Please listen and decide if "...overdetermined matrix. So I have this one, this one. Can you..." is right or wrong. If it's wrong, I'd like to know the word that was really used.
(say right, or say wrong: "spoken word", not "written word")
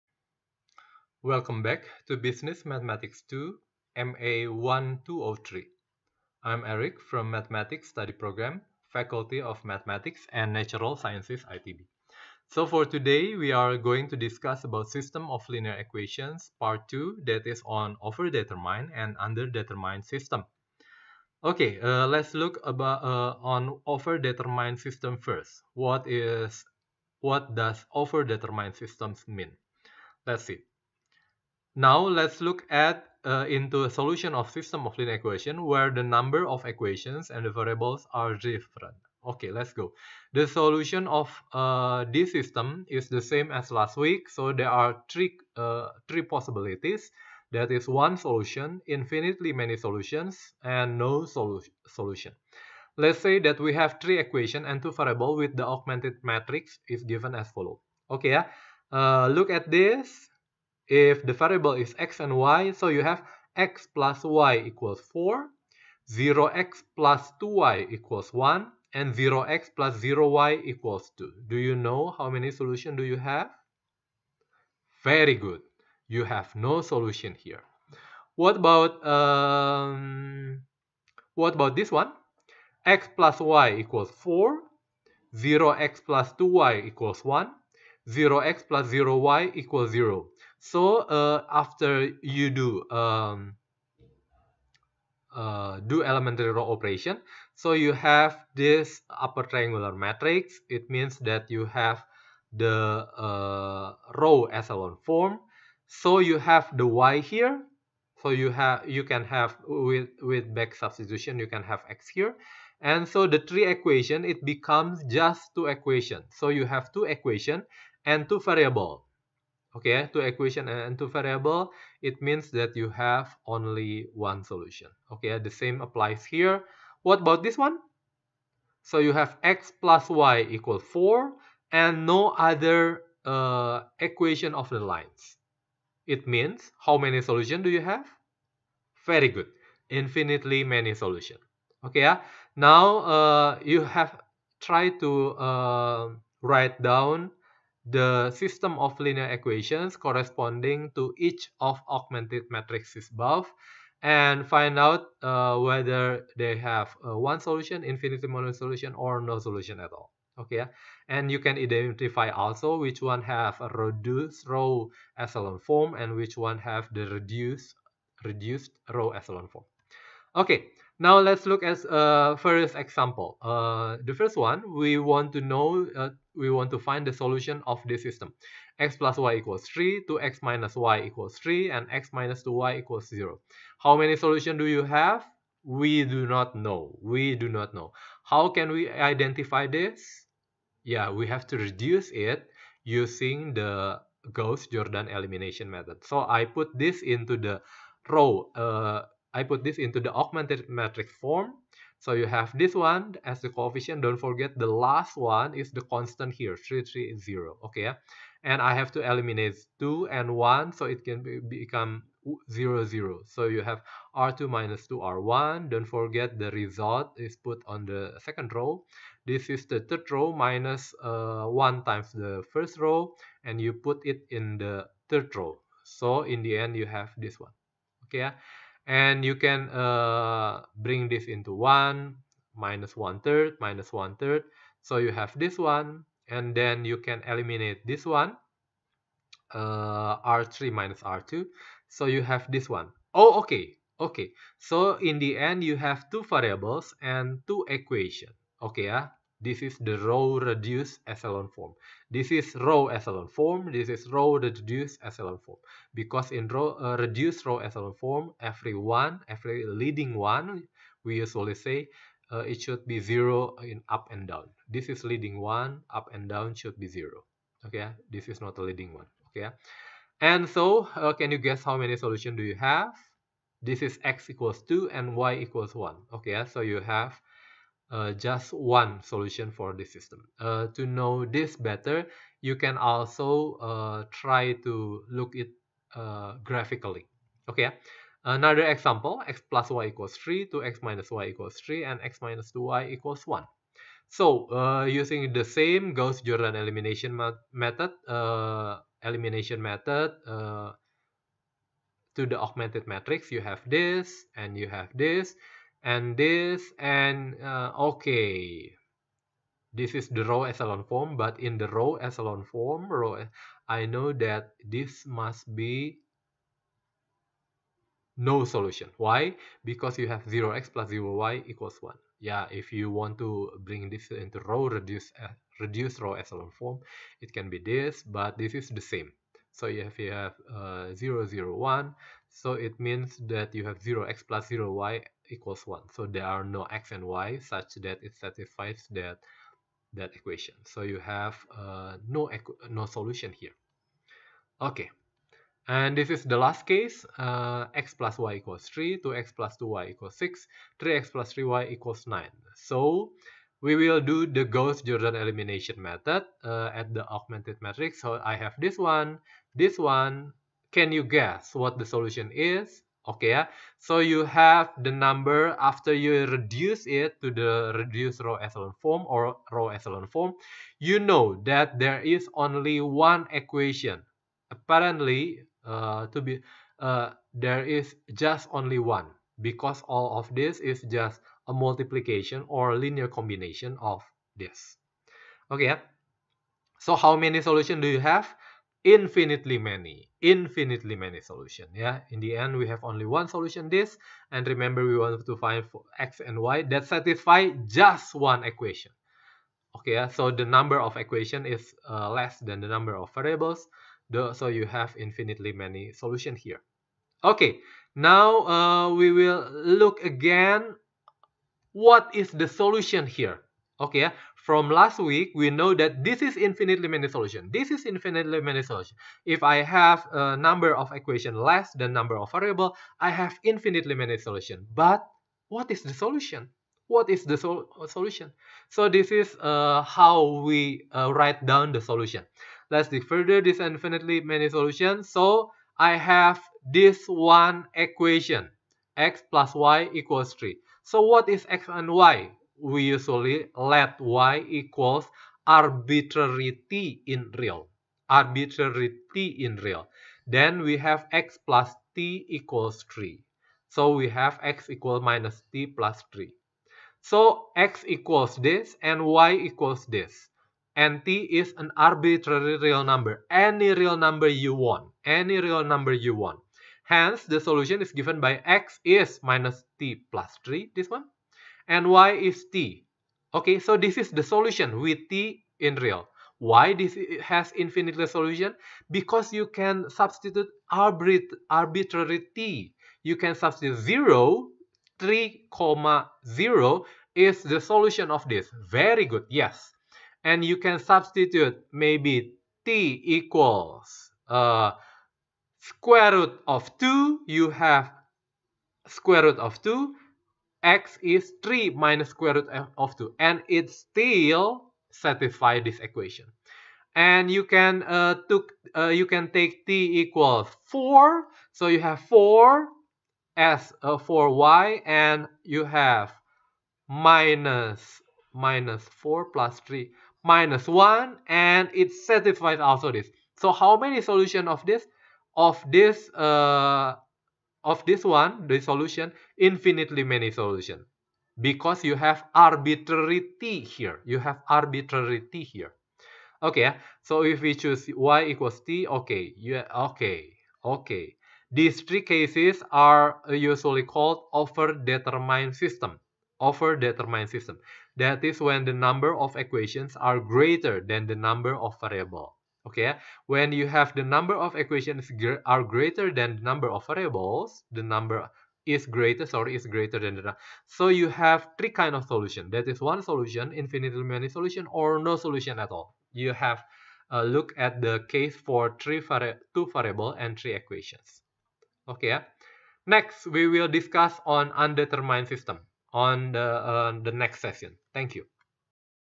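wrong: "augmented", not "overdetermined".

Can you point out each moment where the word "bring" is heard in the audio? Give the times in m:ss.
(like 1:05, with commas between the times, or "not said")
3:50, 5:23.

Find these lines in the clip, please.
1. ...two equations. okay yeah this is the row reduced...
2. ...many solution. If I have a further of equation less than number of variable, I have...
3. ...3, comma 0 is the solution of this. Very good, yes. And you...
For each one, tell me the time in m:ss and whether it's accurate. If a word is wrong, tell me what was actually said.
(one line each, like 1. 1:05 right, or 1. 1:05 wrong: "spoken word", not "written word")
1. 4:07 right
2. 6:58 wrong: "number", not "further"
3. 8:04 right.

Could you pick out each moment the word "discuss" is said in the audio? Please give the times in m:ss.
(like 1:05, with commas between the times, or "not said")
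0:14, 9:33.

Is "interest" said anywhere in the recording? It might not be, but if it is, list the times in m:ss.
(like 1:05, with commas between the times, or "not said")
not said.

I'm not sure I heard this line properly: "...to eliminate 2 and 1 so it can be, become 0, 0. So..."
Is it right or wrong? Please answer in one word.
right.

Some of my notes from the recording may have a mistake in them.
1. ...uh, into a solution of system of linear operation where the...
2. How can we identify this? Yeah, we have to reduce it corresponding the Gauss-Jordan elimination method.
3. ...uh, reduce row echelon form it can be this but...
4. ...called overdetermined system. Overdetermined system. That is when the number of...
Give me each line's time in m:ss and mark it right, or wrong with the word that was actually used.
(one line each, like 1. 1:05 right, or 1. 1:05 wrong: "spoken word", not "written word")
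1. 0:33 wrong: "equation", not "operation"
2. 3:08 wrong: "using", not "corresponding"
3. 5:25 right
4. 9:03 right.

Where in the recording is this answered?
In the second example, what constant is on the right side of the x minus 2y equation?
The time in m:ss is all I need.
4:51.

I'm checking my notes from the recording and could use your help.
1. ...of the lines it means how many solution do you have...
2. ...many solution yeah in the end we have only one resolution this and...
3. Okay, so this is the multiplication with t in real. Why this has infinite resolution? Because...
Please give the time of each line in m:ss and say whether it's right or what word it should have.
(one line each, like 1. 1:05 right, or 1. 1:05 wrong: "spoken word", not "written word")
1. 2:14 right
2. 6:30 wrong: "solution", not "resolution"
3. 7:53 wrong: "solution", not "multiplication".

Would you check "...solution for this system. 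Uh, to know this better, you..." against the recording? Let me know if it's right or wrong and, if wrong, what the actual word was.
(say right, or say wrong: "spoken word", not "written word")
right.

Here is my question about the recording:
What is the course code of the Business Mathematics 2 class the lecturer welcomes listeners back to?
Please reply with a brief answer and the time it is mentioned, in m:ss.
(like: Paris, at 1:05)
MA1203, at 0:03.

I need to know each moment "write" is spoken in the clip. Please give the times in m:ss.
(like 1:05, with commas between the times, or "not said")
2:26, 7:11.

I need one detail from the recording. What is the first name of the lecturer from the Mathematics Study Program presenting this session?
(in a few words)
Eric.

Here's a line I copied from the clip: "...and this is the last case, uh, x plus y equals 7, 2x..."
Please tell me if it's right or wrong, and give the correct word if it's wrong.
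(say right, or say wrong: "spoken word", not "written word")
wrong: "3", not "7".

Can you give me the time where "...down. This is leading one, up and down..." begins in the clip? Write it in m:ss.
4:24.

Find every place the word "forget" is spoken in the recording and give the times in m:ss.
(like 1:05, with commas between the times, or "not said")
3:24, 3:35.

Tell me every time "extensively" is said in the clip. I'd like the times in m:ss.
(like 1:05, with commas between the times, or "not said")
not said.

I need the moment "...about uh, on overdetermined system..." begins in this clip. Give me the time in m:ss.
0:22.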